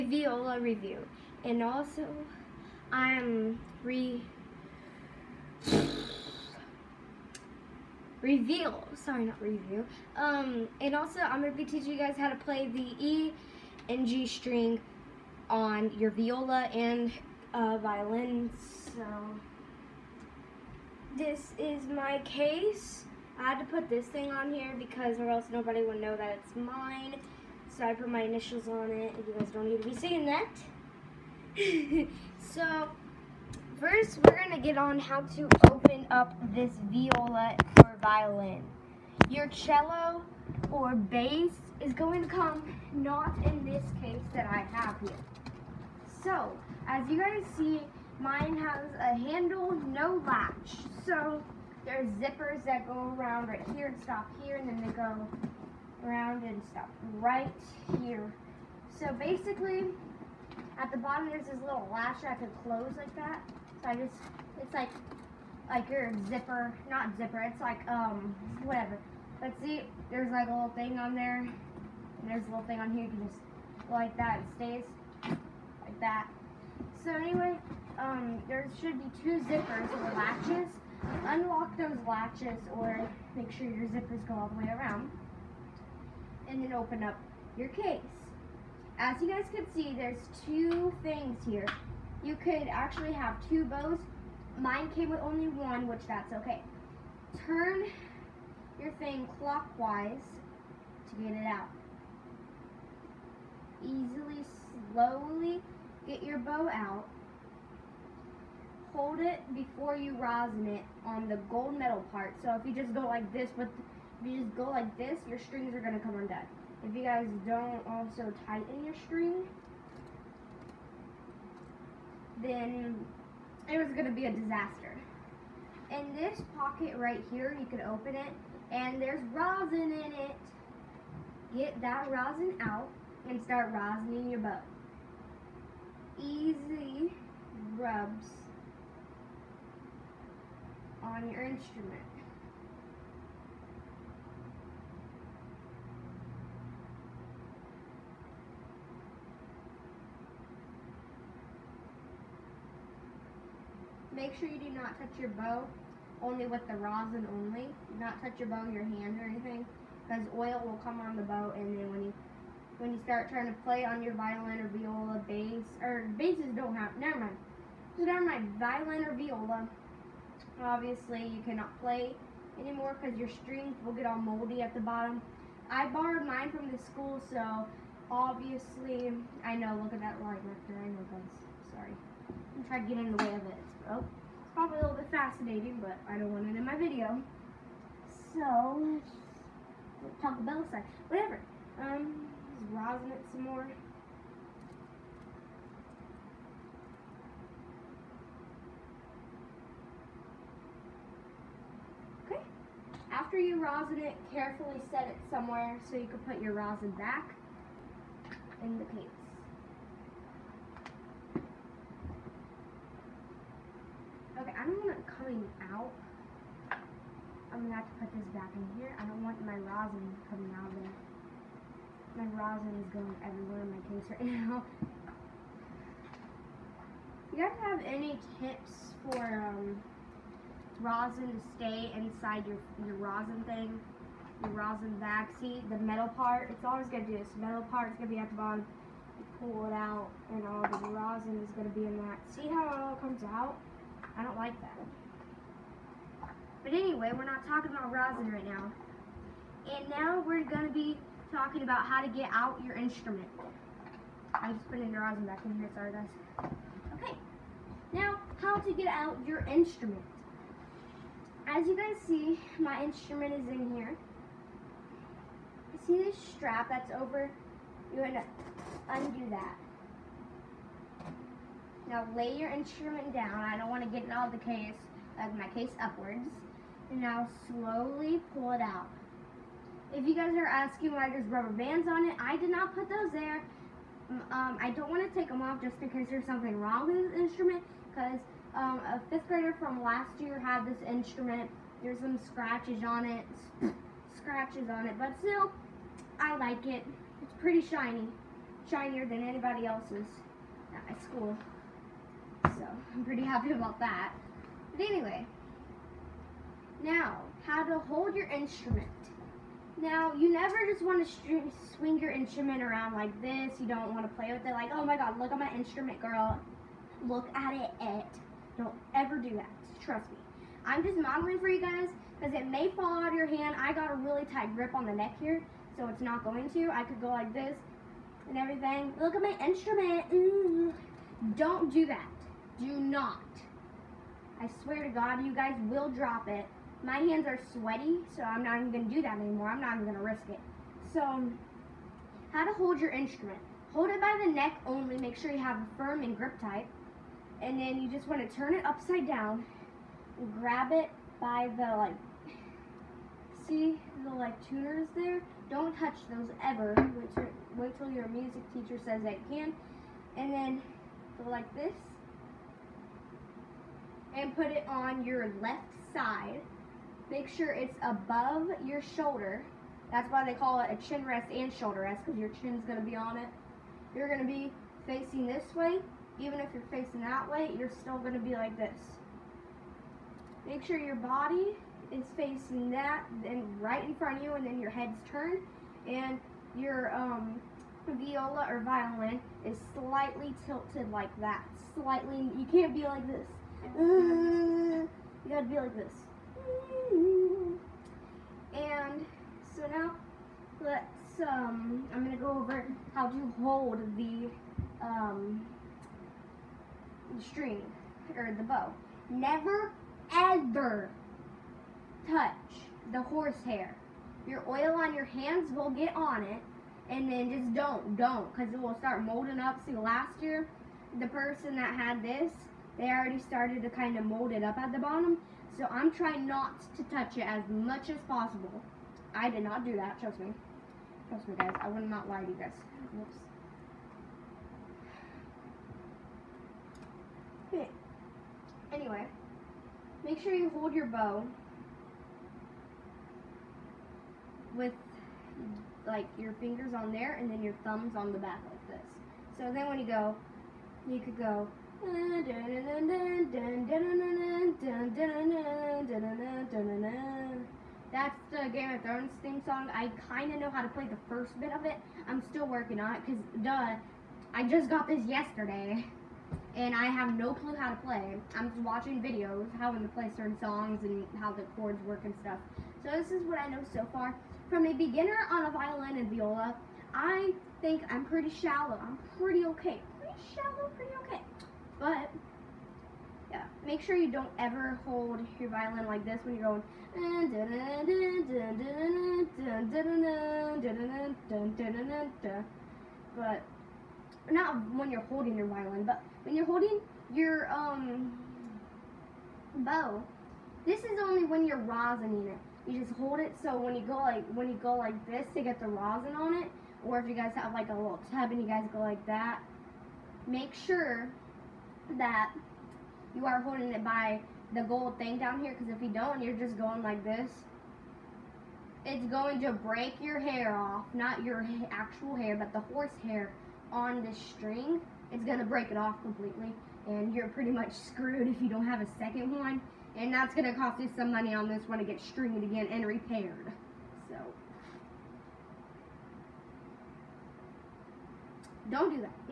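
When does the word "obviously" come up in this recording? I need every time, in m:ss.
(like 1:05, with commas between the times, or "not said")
2:50, 2:58.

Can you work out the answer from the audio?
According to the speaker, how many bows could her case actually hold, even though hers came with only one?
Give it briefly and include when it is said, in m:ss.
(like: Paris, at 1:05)
2 bows, at 1:33.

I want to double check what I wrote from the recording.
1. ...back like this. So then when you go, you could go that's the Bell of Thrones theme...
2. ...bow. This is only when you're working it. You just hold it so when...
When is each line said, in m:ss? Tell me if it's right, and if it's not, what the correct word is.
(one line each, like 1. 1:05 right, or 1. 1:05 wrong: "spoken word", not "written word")
1. 7:28 wrong: "Game", not "Bell"
2. 8:19 wrong: "rosining", not "working".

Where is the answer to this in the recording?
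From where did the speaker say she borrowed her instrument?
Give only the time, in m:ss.
2:56.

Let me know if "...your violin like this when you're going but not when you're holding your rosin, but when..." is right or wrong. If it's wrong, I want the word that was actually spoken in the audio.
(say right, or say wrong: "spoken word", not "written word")
wrong: "violin", not "rosin".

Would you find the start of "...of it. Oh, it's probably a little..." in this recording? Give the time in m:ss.
3:03.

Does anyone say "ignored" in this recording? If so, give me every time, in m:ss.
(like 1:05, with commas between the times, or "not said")
not said.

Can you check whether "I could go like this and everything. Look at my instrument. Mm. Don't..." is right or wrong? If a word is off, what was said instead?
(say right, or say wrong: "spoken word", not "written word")
right.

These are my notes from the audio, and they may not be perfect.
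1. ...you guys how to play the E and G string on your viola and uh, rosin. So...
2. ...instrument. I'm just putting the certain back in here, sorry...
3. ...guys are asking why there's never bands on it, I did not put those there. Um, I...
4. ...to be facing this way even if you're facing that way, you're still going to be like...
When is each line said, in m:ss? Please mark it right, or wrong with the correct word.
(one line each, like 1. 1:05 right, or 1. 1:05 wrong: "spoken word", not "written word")
1. 0:11 wrong: "violin", not "rosin"
2. 4:12 wrong: "rosin", not "certain"
3. 4:40 wrong: "rubber", not "never"
4. 6:14 right.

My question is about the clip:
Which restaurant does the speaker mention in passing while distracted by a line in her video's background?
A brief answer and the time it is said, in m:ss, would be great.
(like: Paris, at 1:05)
Taco Bell, at 3:10.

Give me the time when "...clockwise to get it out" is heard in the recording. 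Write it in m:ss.
1:39.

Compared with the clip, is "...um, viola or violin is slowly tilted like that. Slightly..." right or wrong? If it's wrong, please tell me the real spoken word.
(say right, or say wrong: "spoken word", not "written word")
wrong: "slightly", not "slowly".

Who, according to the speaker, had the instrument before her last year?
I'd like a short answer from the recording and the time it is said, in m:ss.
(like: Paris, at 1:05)
A fifth grader, at 4:48.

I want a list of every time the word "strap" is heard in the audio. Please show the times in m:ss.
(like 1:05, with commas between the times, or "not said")
4:26.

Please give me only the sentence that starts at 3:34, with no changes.
Okay, I don't want it coming out.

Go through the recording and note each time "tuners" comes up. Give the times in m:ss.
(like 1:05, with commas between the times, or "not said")
5:54.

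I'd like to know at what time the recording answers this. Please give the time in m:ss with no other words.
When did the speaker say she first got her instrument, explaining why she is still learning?
7:45.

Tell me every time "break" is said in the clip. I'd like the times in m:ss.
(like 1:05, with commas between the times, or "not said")
8:39, 8:45.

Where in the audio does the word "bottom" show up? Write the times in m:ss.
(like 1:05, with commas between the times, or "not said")
1:00, 2:54, 3:58, 7:04.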